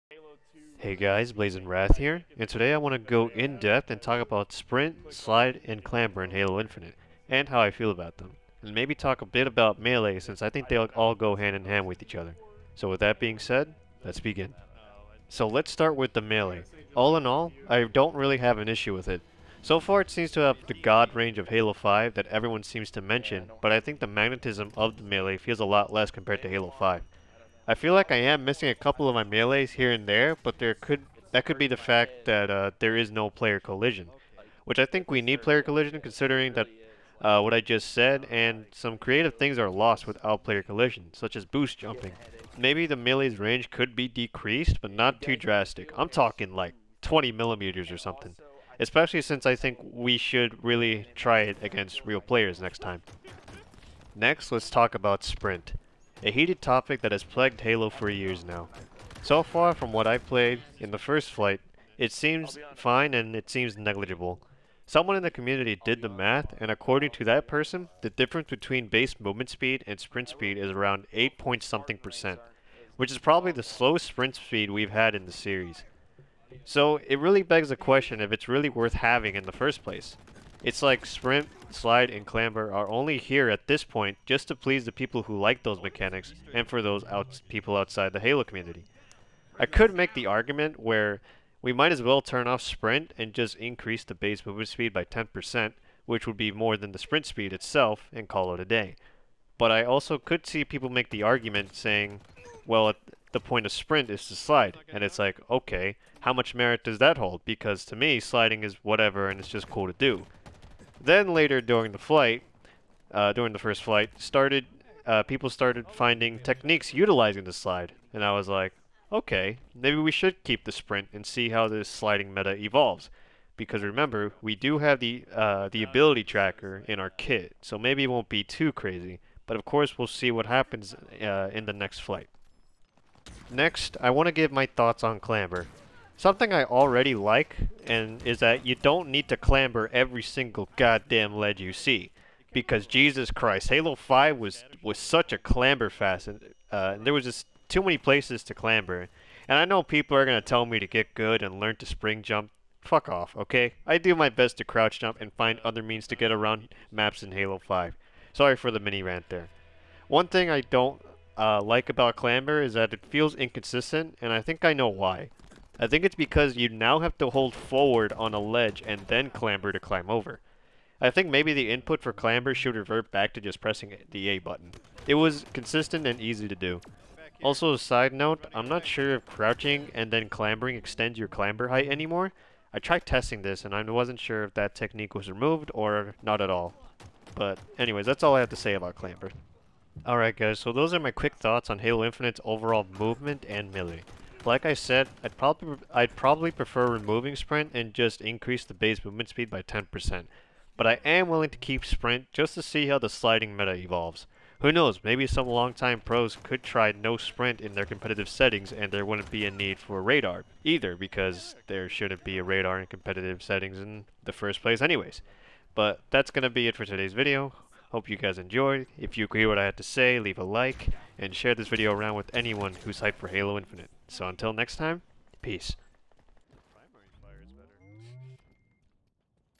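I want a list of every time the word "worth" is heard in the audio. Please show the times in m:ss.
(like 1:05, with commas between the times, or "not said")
1:18.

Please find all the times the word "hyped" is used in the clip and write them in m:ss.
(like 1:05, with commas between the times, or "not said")
3:43.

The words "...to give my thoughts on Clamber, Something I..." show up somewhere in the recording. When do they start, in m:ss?
2:14.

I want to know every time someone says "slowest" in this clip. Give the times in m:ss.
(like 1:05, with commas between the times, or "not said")
1:13.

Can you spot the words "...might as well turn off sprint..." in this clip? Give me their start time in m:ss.
1:31.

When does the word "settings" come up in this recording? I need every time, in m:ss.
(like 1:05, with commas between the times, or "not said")
3:28, 3:33.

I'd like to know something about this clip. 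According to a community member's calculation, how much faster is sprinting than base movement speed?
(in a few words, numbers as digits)
8 point something percent.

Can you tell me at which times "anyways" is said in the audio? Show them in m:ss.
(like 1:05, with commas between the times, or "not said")
3:07, 3:34.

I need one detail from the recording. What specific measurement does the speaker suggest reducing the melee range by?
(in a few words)
20 millimeters.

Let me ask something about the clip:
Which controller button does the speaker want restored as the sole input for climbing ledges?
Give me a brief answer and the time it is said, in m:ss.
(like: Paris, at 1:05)
A button, at 2:54.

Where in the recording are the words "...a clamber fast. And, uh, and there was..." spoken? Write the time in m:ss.
2:25.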